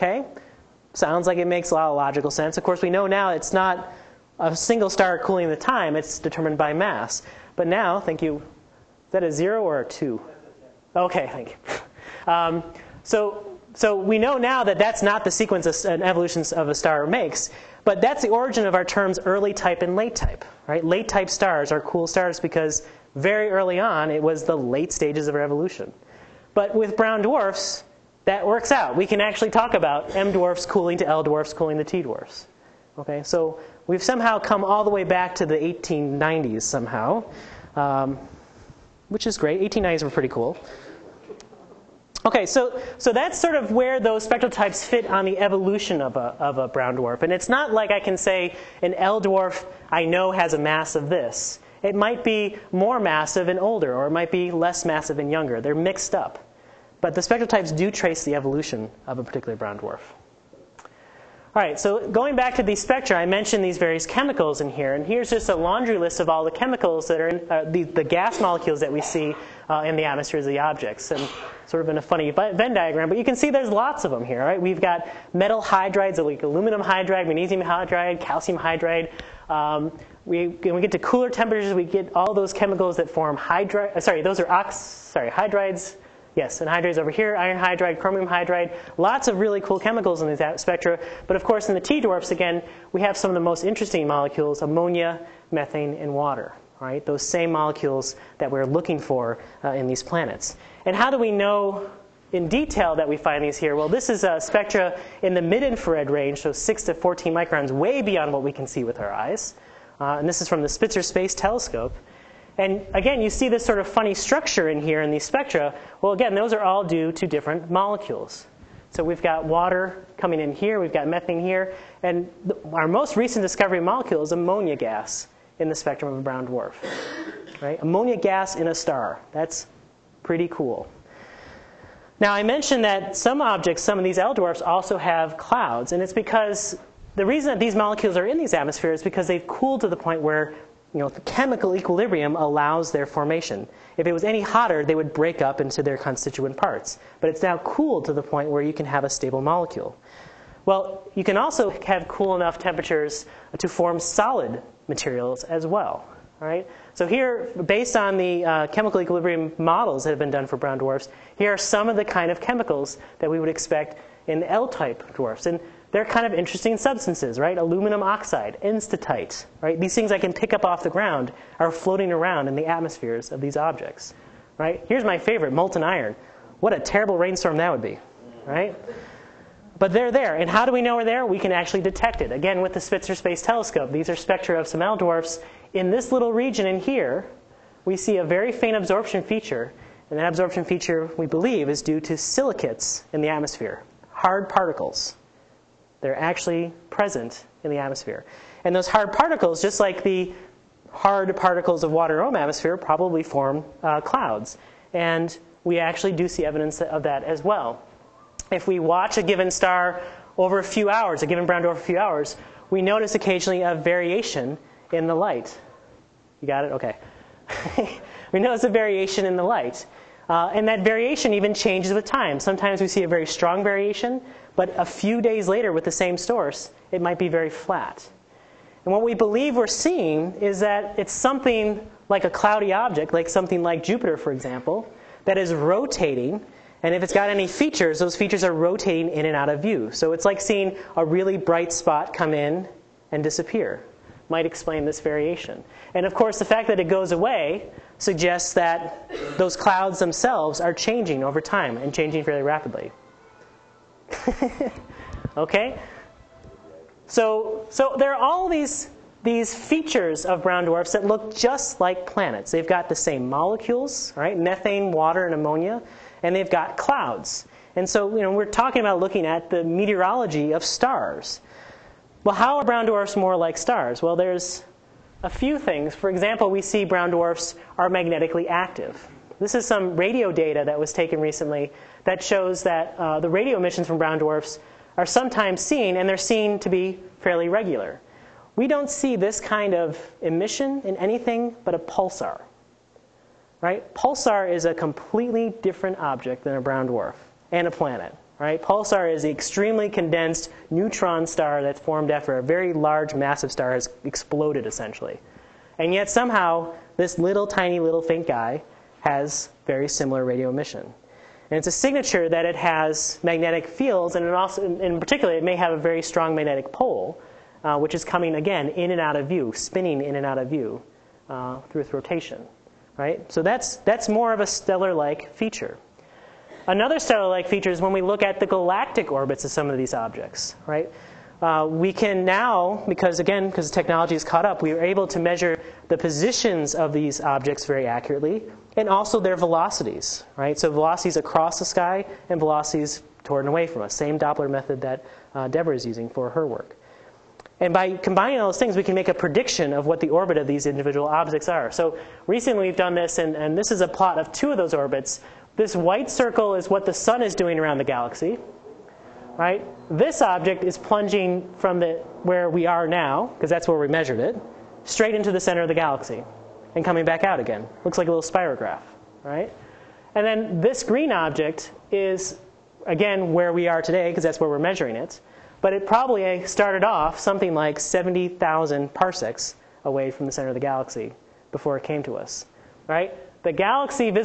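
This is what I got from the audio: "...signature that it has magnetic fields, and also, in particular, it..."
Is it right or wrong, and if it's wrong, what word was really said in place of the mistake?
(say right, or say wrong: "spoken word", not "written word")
right.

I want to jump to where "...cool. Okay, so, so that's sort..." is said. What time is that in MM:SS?
00:40.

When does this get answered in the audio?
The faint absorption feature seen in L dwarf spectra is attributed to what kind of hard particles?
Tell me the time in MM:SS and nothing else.
03:12.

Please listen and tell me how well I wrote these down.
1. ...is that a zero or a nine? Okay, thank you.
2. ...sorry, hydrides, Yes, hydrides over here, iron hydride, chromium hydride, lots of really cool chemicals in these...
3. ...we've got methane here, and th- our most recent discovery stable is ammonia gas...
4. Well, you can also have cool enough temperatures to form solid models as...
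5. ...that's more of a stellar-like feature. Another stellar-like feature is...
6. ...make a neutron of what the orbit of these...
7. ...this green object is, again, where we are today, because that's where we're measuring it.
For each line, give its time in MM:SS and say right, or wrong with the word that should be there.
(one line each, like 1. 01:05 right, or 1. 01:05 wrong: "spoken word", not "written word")
1. 00:08 wrong: "two", not "nine"
2. 01:24 right
3. 02:00 wrong: "molecule", not "stable"
4. 02:30 wrong: "materials", not "models"
5. 05:23 right
6. 05:48 wrong: "prediction", not "neutron"
7. 06:10 right.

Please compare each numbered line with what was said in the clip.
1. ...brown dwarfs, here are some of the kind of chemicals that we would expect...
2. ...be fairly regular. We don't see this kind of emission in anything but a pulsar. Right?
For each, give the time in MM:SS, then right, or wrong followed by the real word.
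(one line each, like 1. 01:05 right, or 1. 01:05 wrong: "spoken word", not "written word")
1. 02:40 right
2. 04:46 right.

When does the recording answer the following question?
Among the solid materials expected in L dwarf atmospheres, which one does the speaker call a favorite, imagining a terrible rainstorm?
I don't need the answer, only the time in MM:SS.
02:55.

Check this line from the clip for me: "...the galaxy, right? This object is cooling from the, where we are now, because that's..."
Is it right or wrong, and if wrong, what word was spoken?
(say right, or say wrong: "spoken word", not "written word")
wrong: "plunging", not "cooling".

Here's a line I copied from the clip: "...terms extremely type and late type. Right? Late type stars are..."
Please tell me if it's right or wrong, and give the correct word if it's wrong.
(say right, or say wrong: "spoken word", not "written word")
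wrong: "early", not "extremely".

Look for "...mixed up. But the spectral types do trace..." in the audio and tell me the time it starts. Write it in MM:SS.
00:55.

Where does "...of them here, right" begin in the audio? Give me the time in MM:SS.
01:14.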